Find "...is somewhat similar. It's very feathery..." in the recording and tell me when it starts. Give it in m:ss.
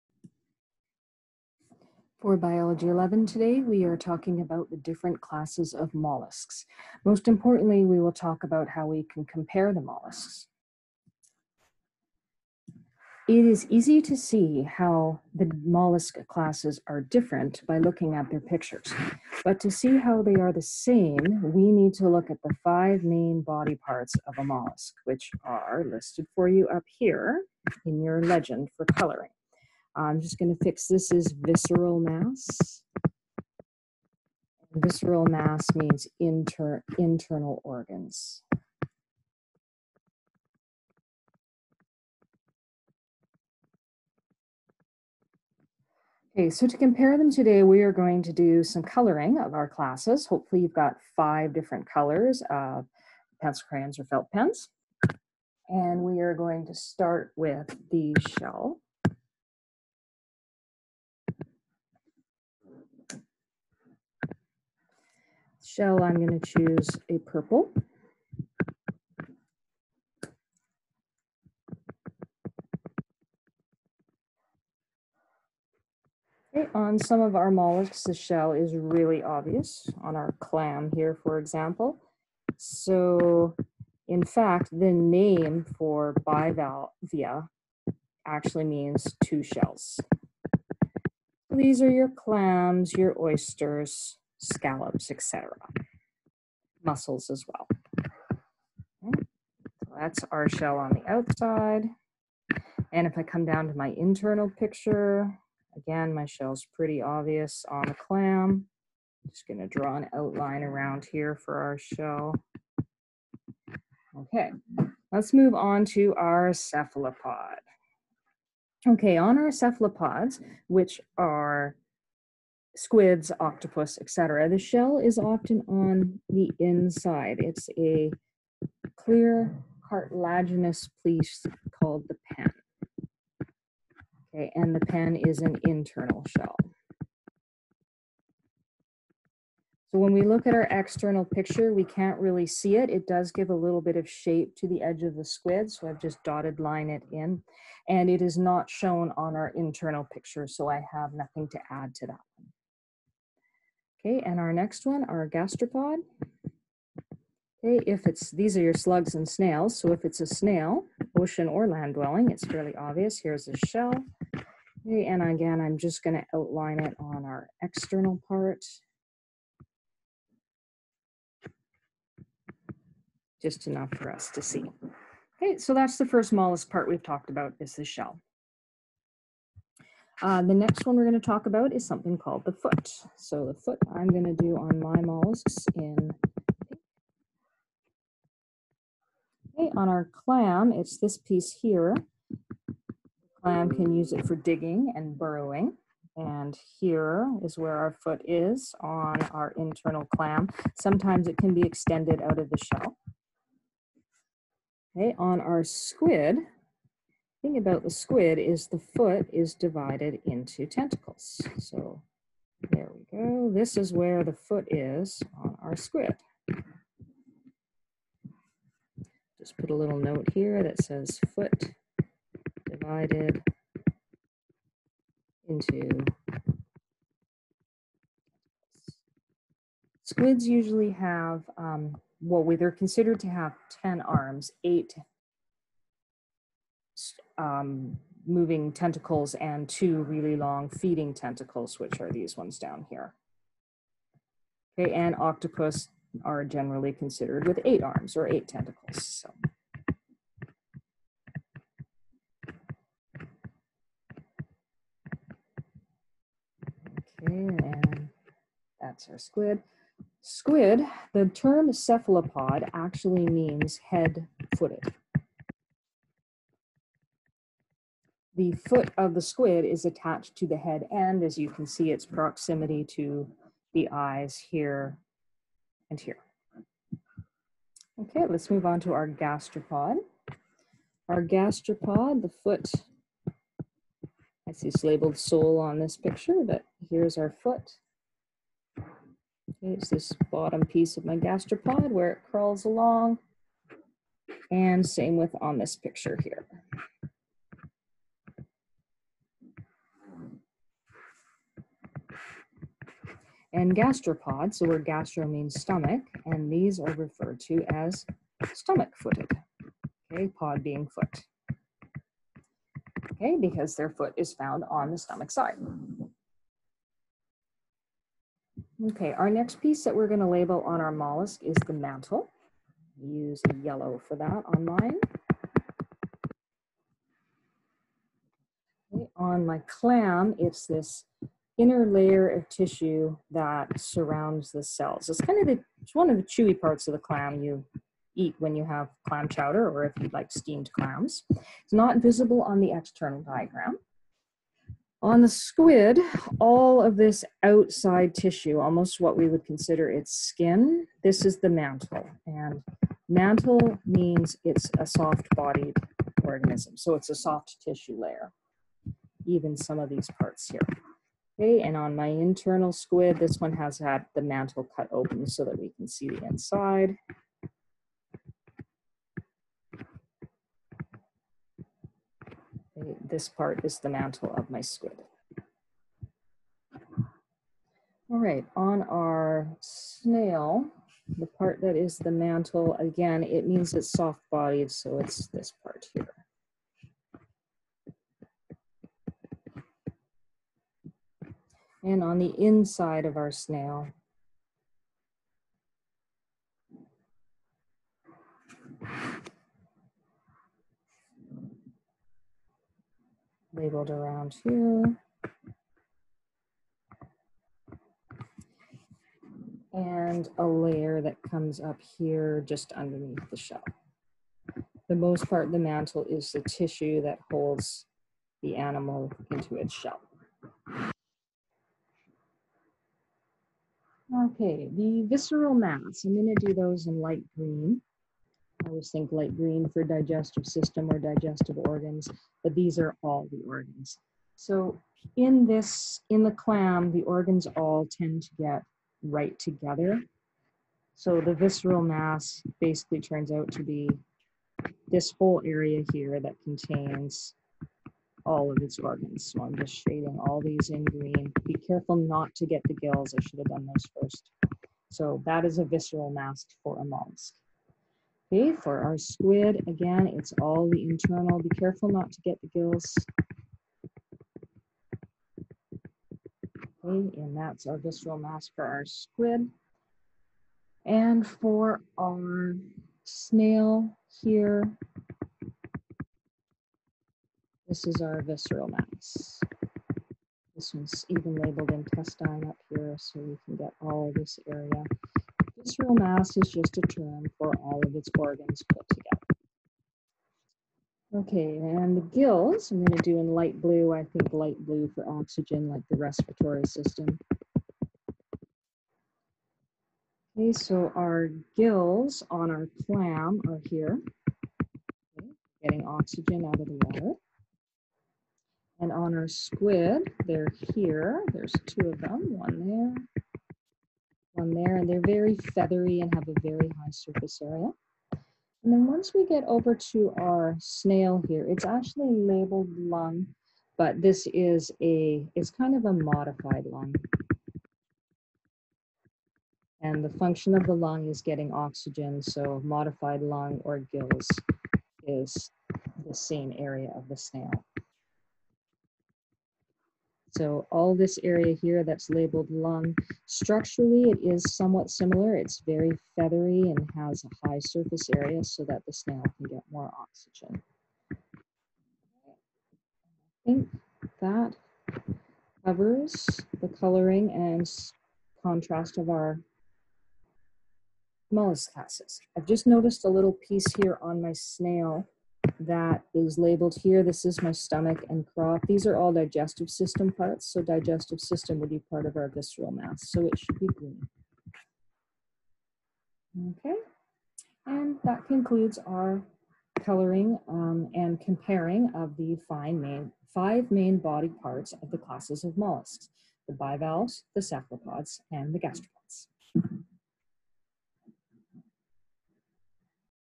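9:04.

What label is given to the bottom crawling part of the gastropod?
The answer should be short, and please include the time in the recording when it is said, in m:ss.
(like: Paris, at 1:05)
sole, at 4:45.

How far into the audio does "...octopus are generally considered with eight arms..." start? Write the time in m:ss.
4:05.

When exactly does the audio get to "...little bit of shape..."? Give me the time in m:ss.
2:23.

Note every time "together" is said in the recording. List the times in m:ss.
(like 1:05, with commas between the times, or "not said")
7:19, 8:08.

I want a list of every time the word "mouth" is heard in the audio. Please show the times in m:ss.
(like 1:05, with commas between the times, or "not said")
not said.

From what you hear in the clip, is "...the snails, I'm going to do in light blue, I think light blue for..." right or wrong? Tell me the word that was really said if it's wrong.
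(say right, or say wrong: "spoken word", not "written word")
wrong: "gills", not "snails".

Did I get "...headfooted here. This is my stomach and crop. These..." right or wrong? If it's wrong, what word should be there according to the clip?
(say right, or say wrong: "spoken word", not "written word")
wrong: "labeled", not "headfooted".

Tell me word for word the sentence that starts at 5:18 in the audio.
Okay, our next piece that we're going to label on our mollusk is the mantle.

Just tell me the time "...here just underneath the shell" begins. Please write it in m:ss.
6:51.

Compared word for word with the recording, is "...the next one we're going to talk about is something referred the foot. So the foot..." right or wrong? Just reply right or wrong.
wrong.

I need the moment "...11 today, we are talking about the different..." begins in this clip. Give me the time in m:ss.
0:02.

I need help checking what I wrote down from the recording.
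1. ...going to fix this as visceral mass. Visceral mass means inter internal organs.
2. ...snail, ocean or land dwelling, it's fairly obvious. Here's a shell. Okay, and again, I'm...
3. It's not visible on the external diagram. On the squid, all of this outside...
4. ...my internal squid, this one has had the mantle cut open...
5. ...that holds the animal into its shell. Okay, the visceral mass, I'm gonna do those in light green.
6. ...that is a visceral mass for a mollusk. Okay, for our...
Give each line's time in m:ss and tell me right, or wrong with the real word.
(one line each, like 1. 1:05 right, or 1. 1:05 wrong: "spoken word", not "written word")
1. 0:30 right
2. 2:40 right
3. 5:41 right
4. 6:01 right
5. 6:57 right
6. 7:35 right.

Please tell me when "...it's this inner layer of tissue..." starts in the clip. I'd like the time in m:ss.
5:30.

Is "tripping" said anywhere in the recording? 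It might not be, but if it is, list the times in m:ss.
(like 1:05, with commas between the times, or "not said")
not said.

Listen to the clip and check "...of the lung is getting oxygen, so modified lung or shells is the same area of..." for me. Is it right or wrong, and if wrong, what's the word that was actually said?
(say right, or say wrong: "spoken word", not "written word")
wrong: "gills", not "shells".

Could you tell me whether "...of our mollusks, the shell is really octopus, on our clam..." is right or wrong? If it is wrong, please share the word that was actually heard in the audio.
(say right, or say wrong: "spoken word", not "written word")
wrong: "obvious", not "octopus".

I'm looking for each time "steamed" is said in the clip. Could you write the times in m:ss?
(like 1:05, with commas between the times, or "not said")
5:40.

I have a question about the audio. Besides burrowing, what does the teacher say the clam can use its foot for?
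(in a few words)
digging.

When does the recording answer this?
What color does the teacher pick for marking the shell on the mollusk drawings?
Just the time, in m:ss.
1:07.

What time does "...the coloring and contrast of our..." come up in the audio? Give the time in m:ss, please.
9:16.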